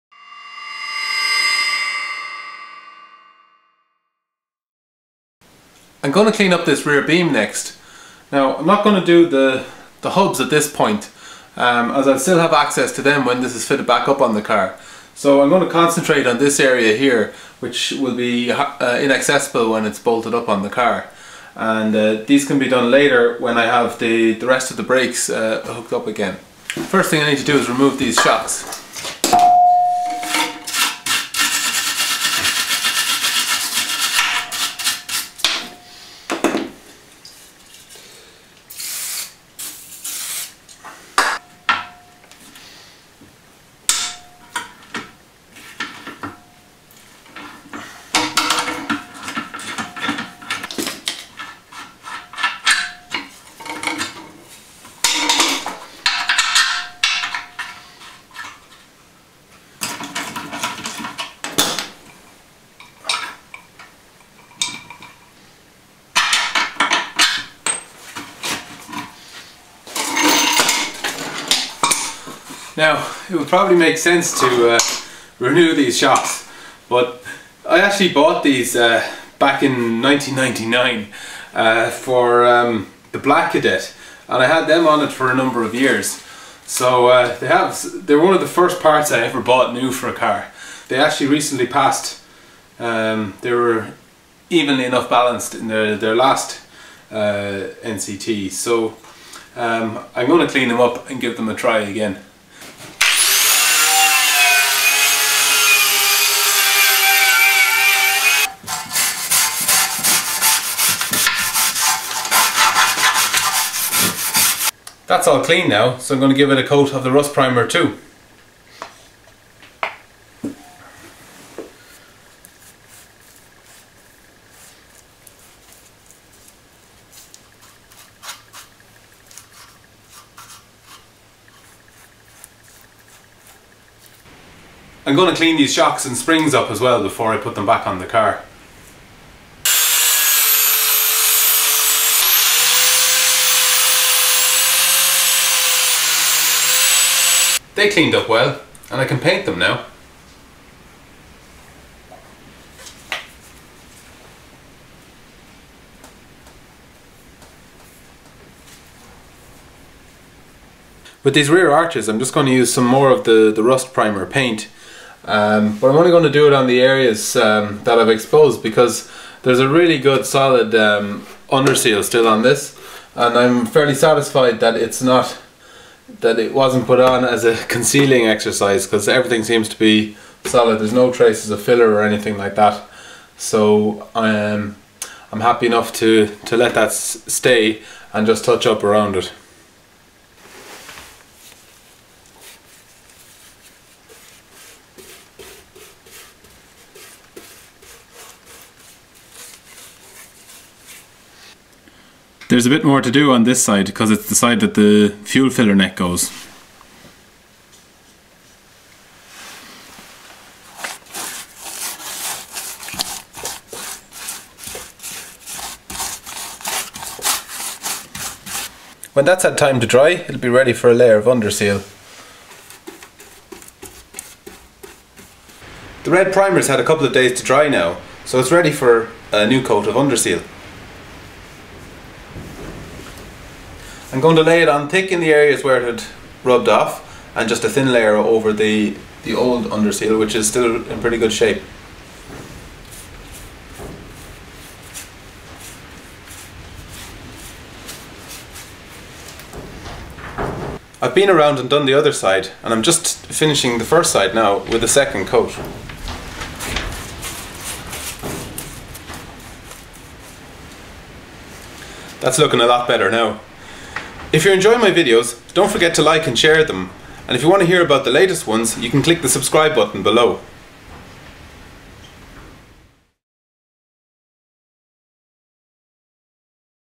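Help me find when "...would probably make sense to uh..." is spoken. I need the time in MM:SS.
01:13.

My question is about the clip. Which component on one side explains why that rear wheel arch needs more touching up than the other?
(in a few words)
fuel filler neck.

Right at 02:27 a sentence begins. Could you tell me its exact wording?
They cleaned up well, and I can paint them now.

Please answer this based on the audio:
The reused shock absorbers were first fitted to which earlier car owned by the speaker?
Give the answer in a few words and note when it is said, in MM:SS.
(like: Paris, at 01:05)
Black Kadett, at 01:23.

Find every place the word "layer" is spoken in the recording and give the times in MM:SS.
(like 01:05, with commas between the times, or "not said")
03:40, 03:57.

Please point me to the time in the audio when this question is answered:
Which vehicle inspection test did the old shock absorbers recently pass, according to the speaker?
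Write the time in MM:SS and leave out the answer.
01:37.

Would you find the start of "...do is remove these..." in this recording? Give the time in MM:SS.
00:27.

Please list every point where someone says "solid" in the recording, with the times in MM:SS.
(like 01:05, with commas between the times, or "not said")
02:50, 03:00.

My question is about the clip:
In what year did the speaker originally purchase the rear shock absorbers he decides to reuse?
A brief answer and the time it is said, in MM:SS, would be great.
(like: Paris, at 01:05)
1999, at 01:20.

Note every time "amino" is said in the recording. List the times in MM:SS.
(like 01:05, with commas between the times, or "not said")
not said.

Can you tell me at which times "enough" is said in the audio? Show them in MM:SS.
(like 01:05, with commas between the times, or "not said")
01:34, 03:05.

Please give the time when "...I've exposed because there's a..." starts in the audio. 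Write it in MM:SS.
02:47.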